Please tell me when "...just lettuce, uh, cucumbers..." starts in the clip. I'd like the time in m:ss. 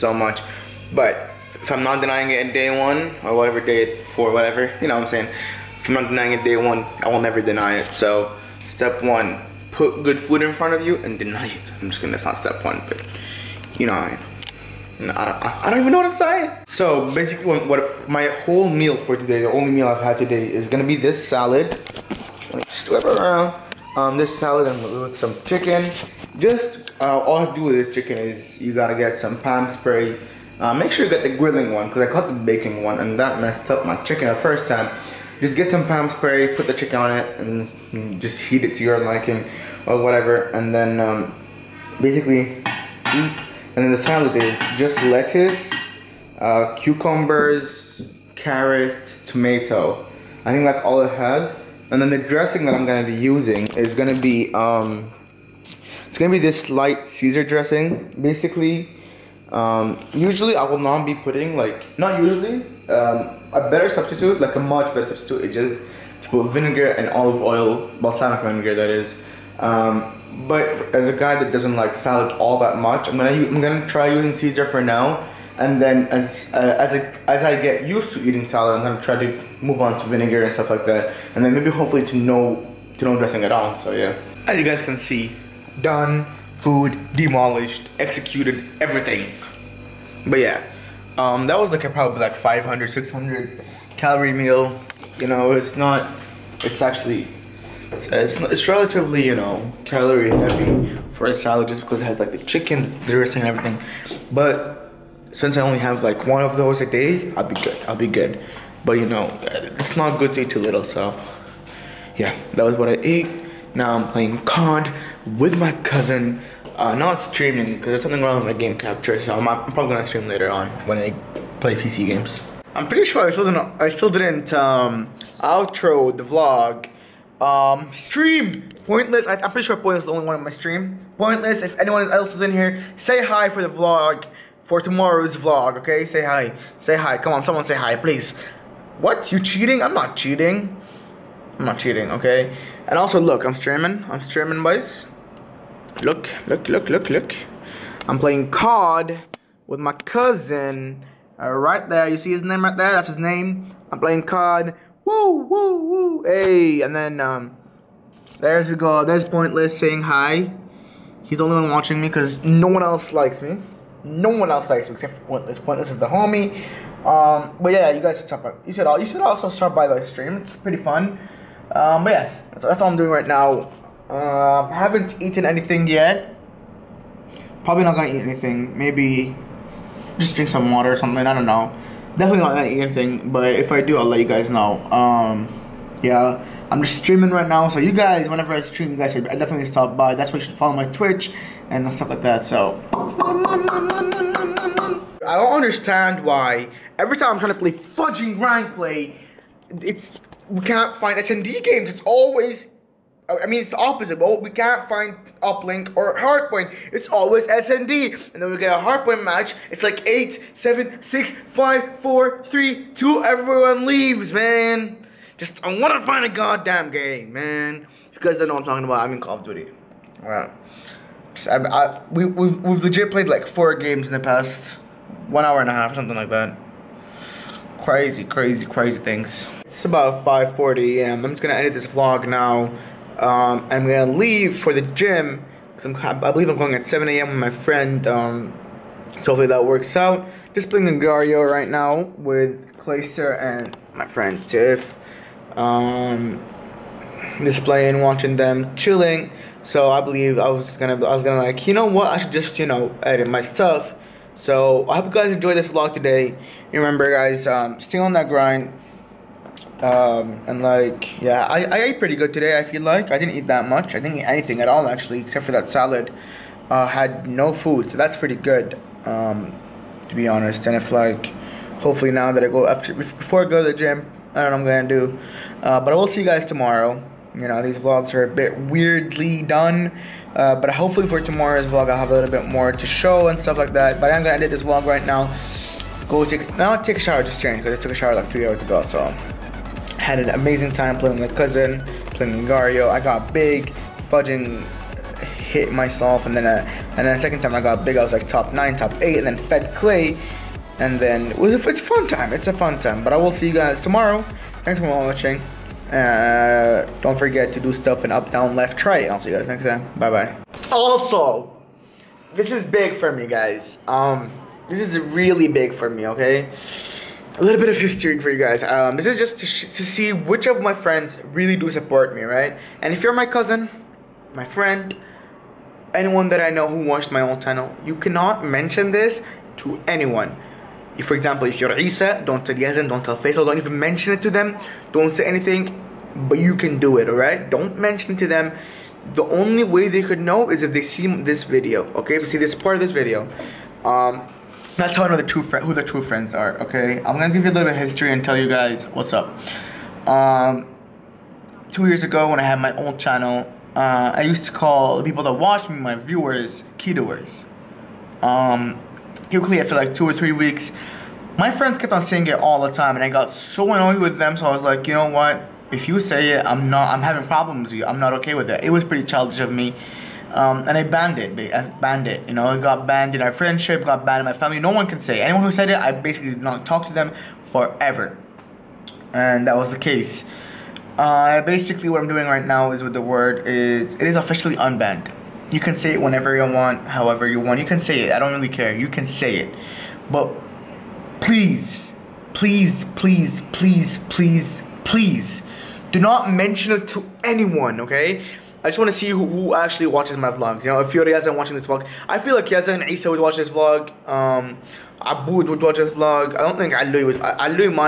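0:44.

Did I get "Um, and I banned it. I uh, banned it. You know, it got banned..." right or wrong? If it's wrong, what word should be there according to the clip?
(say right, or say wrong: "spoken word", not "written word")
right.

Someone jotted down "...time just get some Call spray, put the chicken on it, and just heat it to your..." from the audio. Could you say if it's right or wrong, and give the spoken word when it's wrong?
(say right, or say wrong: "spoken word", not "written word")
wrong: "Pam", not "Call".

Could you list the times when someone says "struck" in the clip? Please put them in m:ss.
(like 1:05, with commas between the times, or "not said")
not said.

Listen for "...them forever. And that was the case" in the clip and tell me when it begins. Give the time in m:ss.
6:16.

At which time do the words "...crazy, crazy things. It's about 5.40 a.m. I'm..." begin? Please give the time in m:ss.
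3:48.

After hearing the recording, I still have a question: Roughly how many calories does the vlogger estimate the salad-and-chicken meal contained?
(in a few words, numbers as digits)
500-600.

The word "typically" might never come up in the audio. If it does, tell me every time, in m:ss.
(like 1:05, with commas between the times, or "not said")
5:59.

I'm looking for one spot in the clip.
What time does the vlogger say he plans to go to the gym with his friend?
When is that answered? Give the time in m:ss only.
3:56.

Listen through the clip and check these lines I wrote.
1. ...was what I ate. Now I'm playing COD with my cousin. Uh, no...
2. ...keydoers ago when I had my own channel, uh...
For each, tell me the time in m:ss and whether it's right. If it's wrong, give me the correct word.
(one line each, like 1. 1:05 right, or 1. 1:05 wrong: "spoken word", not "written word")
1. 1:52 right
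2. 5:51 wrong: "years", not "keydoers".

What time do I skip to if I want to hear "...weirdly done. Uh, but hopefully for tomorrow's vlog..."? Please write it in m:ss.
4:38.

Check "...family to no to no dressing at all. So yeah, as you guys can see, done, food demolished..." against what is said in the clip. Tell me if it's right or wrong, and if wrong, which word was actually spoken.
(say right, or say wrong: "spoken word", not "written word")
wrong: "hopefully", not "family".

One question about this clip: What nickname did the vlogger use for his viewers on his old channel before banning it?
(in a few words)
Keydoers.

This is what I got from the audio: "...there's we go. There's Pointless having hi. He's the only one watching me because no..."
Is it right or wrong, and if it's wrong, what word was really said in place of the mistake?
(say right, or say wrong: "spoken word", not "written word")
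wrong: "saying", not "having".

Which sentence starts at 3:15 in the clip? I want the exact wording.
I don't understand why every time I'm trying to play fudging rank play, it's we can't find SND games.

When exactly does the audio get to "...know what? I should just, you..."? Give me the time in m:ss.
4:11.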